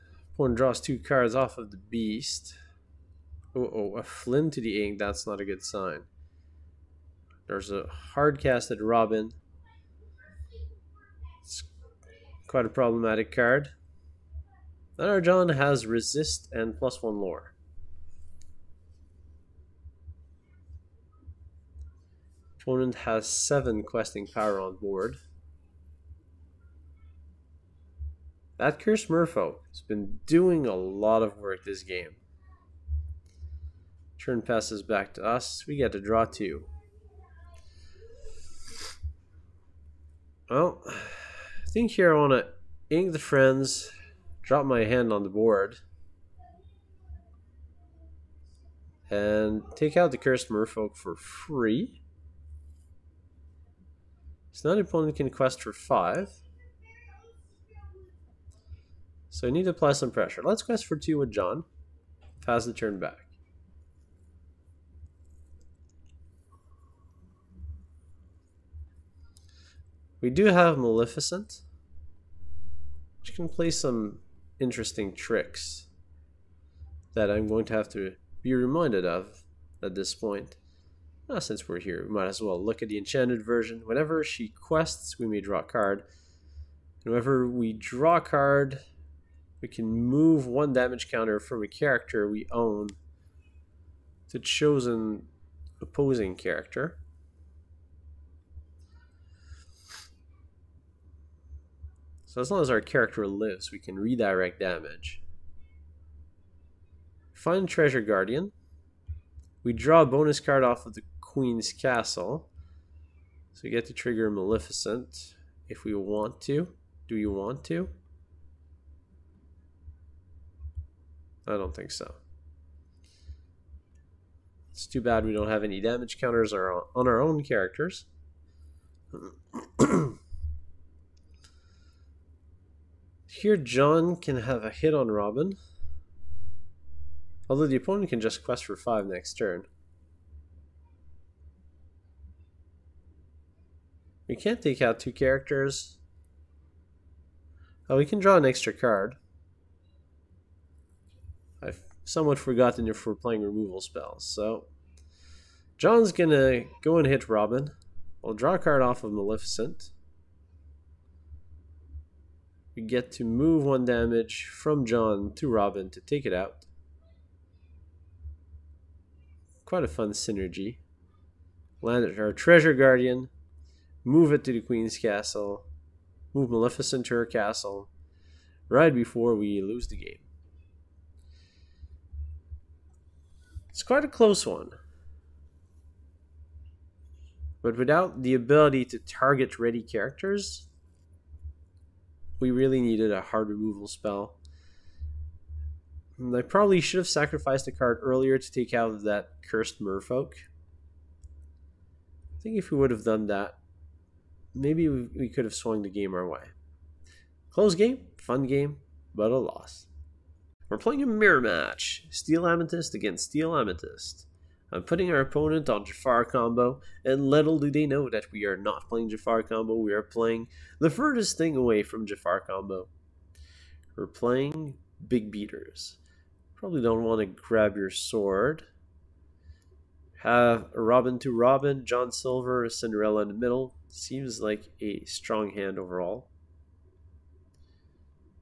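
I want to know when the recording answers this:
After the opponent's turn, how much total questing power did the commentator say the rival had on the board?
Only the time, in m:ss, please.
0:23.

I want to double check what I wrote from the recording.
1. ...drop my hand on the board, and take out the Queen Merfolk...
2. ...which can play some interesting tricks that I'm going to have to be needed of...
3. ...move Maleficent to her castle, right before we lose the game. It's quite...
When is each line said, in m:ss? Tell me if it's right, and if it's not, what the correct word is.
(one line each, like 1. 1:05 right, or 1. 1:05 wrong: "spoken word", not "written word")
1. 0:44 wrong: "Cursed", not "Queen"
2. 1:13 wrong: "reminded", not "needed"
3. 2:56 right.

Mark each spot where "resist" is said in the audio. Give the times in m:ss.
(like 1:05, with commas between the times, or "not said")
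0:15.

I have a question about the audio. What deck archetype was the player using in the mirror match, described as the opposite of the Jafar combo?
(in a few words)
Big Beaters.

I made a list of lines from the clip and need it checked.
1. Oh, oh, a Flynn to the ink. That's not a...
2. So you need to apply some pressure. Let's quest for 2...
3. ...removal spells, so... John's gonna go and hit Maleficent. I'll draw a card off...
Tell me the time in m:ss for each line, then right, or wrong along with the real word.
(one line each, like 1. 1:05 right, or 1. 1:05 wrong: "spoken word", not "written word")
1. 0:03 right
2. 0:59 right
3. 2:33 wrong: "Robin", not "Maleficent".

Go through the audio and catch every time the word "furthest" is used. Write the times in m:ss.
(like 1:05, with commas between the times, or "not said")
3:40.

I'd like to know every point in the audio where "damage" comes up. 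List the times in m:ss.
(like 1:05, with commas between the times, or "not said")
1:30, 1:44, 2:05, 2:43.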